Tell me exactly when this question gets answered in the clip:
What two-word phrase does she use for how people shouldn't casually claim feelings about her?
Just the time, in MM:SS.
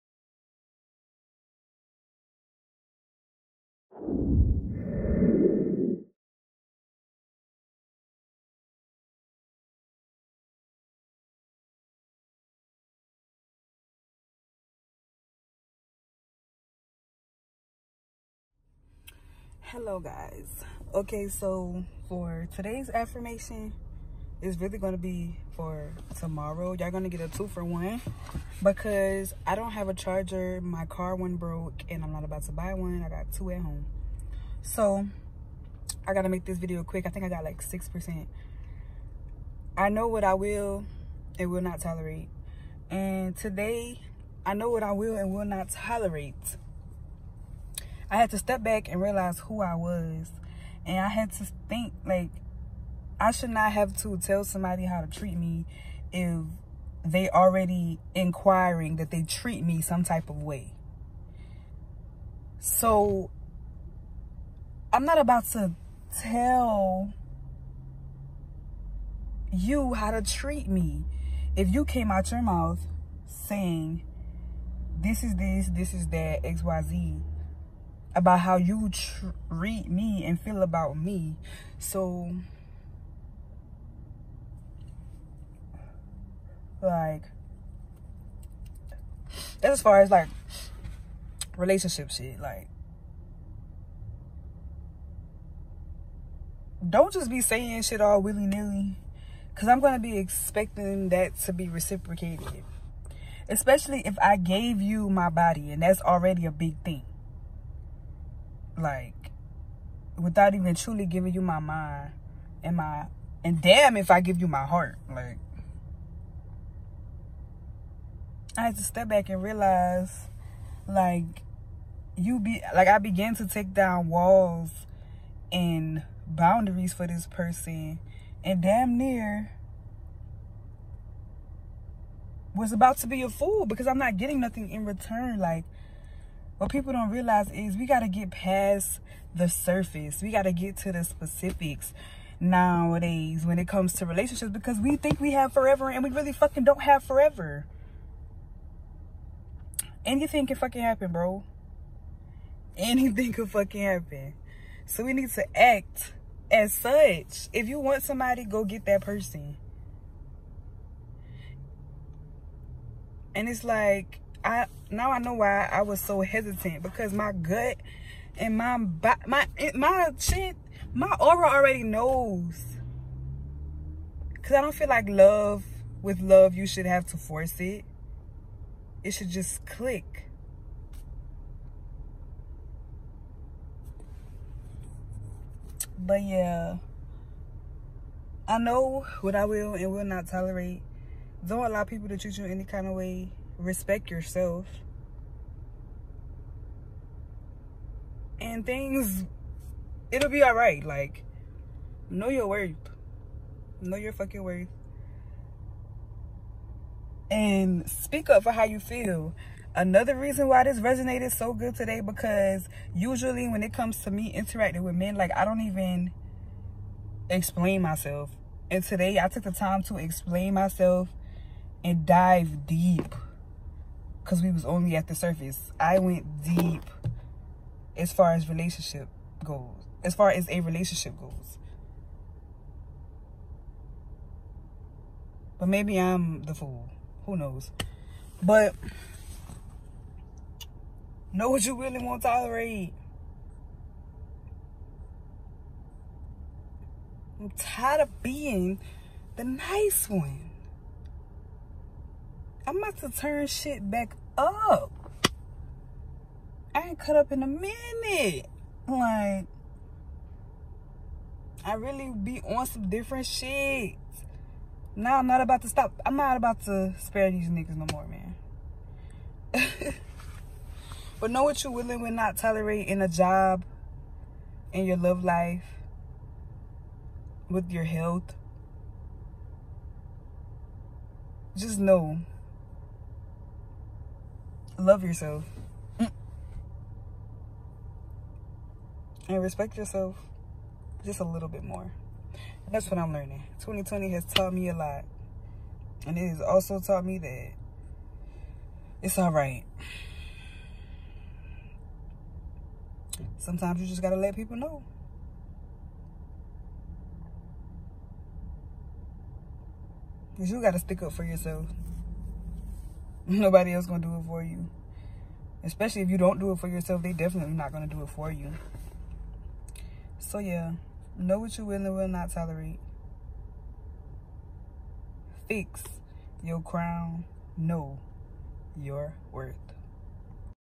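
01:38.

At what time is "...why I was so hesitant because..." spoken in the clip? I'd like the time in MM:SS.
02:45.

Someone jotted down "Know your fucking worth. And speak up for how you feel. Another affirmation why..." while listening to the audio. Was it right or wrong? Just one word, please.
wrong.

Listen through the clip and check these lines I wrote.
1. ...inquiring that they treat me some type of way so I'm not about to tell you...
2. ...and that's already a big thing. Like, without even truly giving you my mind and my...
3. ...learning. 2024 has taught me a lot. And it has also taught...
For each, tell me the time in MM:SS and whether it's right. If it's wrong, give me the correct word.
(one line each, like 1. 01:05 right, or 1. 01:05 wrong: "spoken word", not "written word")
1. 00:58 right
2. 01:45 right
3. 04:53 wrong: "2020", not "2024".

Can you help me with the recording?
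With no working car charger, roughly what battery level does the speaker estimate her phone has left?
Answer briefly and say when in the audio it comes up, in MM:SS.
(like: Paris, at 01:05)
6%, at 00:37.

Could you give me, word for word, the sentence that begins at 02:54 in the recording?
Cause I don't feel like love with love you should have to force it.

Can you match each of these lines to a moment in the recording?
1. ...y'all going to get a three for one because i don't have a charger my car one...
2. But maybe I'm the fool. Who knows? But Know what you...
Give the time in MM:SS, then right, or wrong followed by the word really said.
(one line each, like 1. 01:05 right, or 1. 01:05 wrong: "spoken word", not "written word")
1. 00:26 wrong: "two", not "three"
2. 03:55 right.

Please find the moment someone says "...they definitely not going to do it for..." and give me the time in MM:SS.
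05:17.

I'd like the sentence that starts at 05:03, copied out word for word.
Sometimes you just got to let people know.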